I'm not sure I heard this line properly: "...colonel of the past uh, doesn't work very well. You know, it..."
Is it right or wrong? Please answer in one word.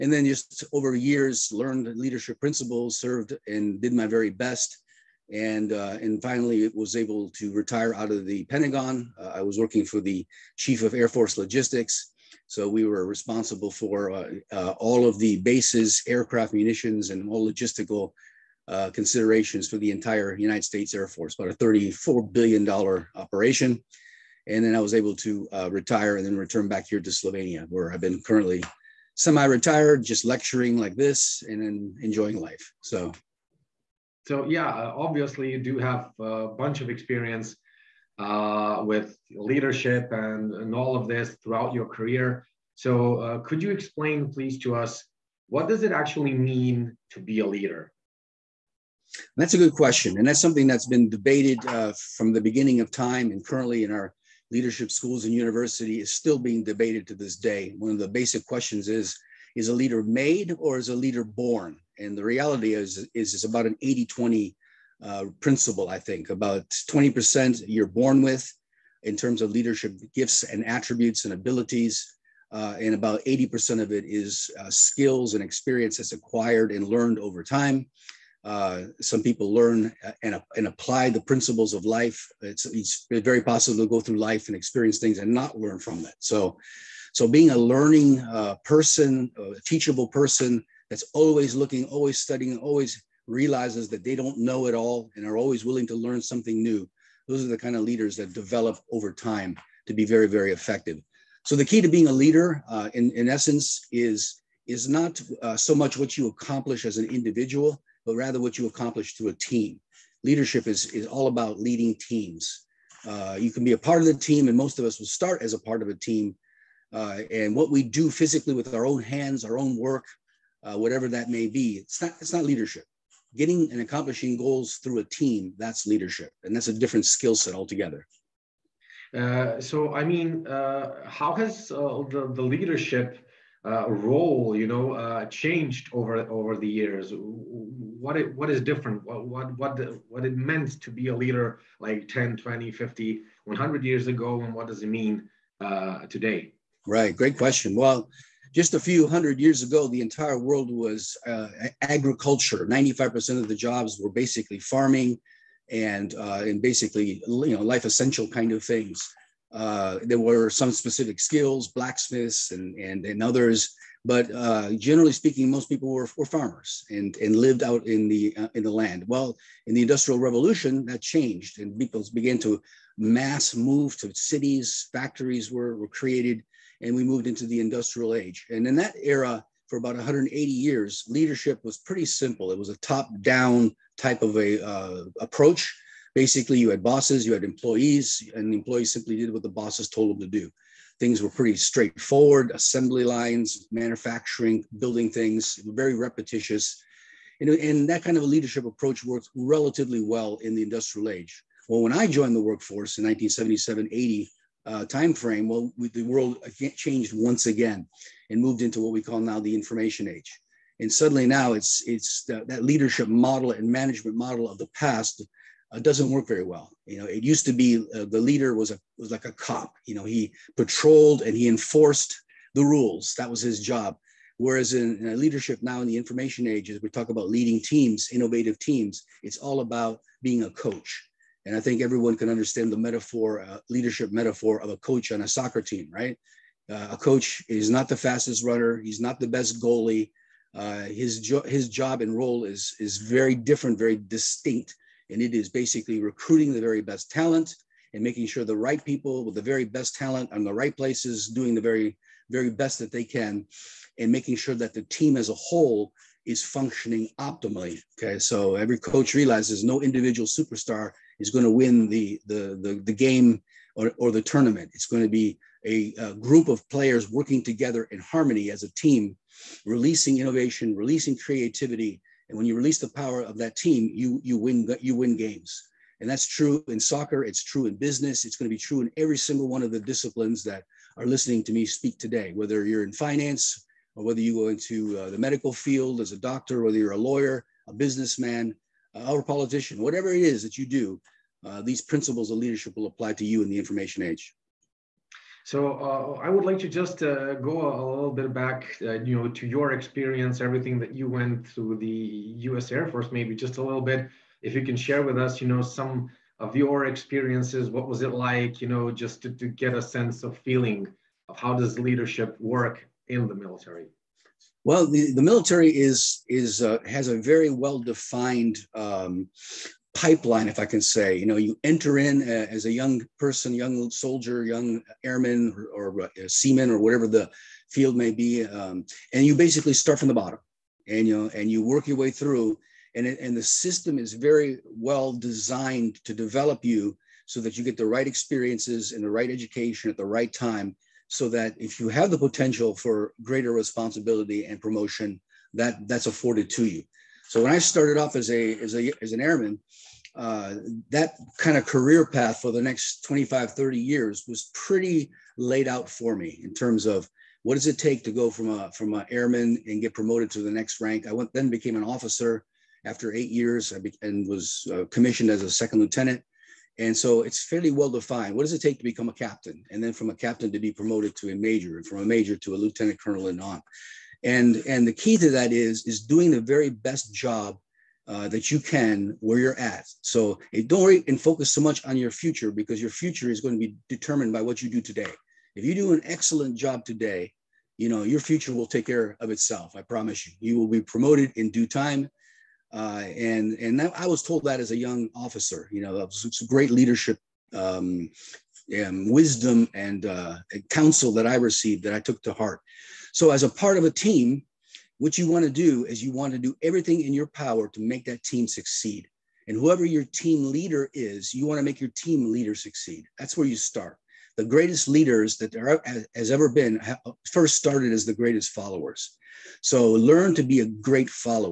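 wrong.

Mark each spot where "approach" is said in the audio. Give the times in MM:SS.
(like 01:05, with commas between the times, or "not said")
03:05, 03:18.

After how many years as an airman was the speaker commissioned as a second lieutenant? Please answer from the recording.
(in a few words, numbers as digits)
8.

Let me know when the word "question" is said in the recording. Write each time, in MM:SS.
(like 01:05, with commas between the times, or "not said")
00:49, 00:58, 02:27.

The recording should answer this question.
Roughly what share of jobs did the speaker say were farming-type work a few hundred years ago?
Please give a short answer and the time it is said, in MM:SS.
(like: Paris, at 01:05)
95%, at 02:32.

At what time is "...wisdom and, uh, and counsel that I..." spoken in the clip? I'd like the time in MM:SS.
06:39.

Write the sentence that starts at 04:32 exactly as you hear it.
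And when you release the power of that team, you, you, win, you win games.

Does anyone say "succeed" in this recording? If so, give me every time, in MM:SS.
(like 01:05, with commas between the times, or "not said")
06:48, 06:52.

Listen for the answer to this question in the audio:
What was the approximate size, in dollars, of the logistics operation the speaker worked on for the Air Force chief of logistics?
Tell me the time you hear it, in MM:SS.
00:21.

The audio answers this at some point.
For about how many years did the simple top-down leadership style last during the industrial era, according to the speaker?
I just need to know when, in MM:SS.
02:59.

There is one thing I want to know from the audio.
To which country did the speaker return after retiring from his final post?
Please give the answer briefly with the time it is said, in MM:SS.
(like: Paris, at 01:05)
Slovenia, at 00:27.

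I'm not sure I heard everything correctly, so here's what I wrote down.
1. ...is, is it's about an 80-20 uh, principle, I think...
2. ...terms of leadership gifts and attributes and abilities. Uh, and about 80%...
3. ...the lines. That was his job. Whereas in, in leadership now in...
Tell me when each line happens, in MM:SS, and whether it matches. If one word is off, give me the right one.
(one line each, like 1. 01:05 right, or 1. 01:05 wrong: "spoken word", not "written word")
1. 01:02 right
2. 01:09 right
3. 03:42 wrong: "rules", not "lines".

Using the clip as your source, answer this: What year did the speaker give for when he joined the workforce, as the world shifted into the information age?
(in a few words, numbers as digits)
1977.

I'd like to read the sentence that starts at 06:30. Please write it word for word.
You will be promoted in due time.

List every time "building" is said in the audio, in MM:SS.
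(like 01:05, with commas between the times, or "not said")
03:14.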